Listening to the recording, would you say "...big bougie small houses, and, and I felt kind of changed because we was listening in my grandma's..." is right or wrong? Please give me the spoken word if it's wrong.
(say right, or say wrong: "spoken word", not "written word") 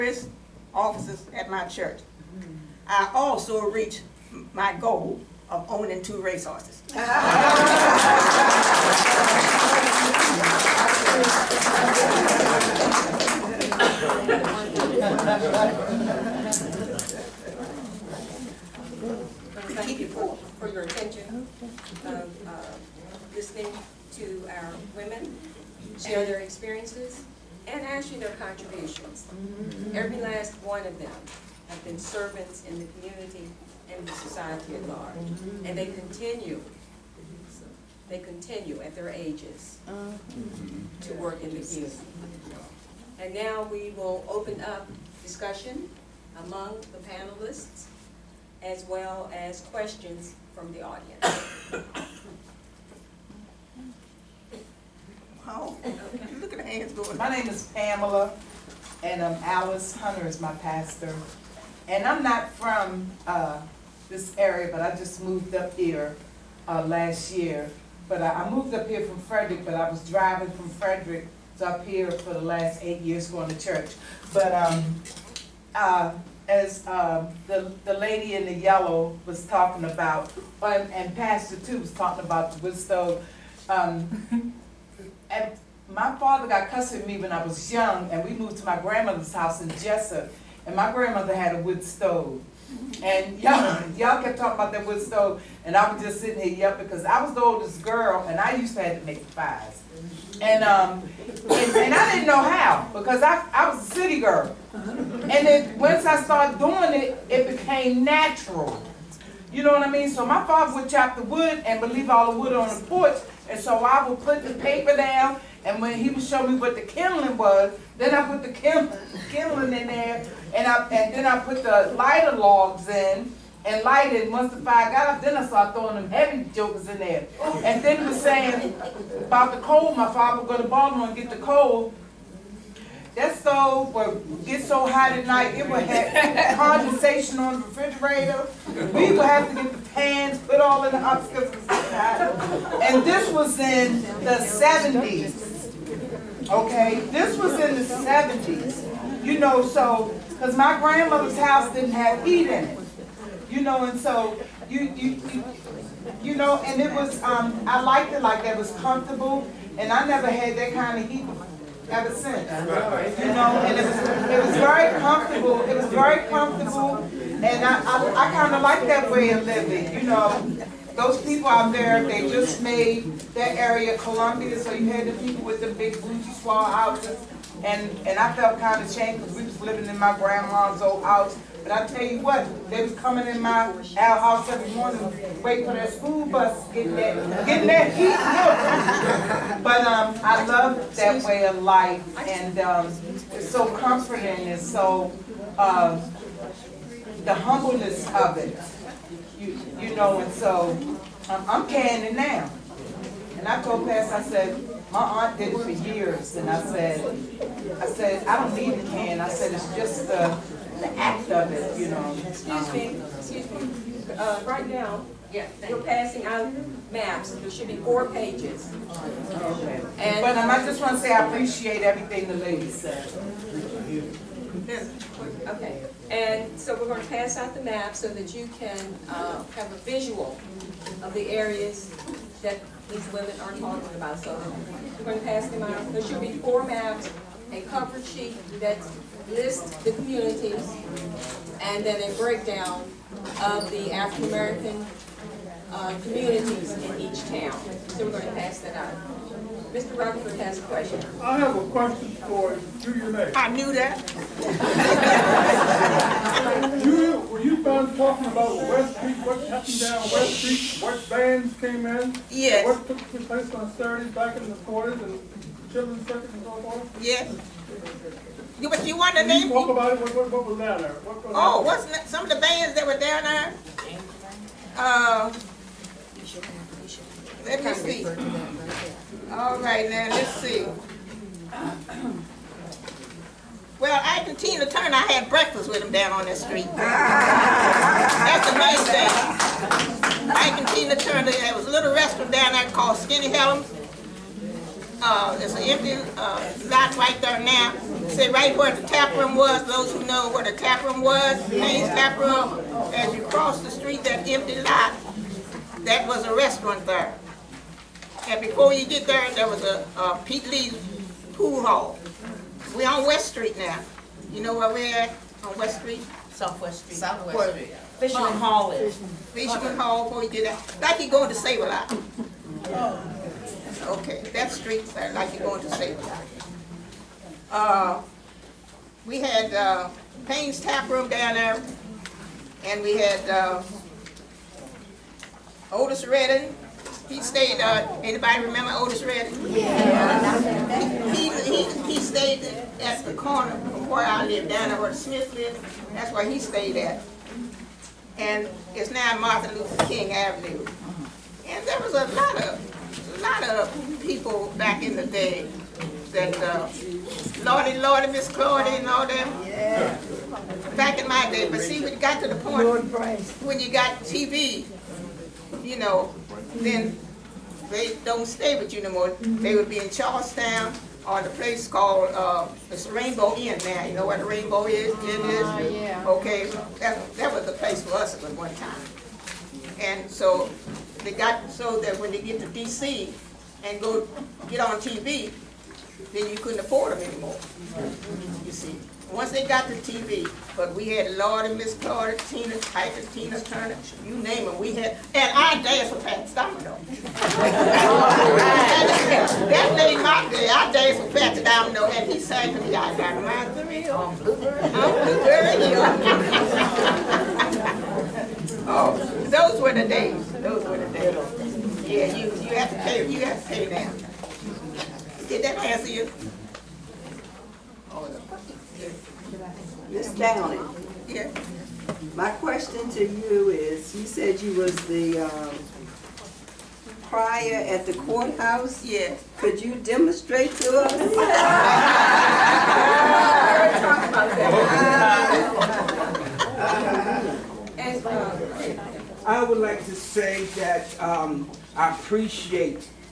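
wrong: "living", not "listening".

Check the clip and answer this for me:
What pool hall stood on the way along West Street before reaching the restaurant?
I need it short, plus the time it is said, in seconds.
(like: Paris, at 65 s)
Pete Lee's pool hall, at 310 s.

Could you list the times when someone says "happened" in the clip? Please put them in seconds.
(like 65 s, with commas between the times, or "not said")
259 s.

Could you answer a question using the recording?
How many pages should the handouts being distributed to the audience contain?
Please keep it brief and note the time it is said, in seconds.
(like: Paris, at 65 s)
4, at 217 s.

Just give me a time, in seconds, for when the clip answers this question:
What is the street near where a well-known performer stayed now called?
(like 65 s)
349 s.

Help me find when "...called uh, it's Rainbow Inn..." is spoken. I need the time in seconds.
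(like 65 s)
371 s.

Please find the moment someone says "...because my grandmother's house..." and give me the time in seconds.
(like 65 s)
150 s.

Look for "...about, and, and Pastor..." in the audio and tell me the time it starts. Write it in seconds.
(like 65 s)
79 s.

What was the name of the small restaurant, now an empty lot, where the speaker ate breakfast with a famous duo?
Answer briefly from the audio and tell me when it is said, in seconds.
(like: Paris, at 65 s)
Skinny Helms, at 292 s.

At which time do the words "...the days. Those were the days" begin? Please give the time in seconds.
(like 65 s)
409 s.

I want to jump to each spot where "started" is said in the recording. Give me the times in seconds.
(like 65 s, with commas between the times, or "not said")
106 s, 125 s.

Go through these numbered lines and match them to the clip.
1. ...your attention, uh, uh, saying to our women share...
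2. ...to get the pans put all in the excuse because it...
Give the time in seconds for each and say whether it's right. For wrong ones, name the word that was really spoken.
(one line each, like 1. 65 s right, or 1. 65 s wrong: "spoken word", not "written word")
1. 20 s wrong: "listening", not "saying"
2. 139 s wrong: "house", not "excuse".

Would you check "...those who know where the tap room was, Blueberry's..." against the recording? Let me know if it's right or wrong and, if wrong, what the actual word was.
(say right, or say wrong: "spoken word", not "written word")
wrong: "Payne", not "Blueberry".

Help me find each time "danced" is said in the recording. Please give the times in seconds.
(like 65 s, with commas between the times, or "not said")
395 s, 400 s.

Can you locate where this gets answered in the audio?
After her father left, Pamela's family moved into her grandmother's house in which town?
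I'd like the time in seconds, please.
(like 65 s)
89 s.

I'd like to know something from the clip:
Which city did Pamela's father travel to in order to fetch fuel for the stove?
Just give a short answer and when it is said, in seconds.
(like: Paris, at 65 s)
Baltimore, at 130 s.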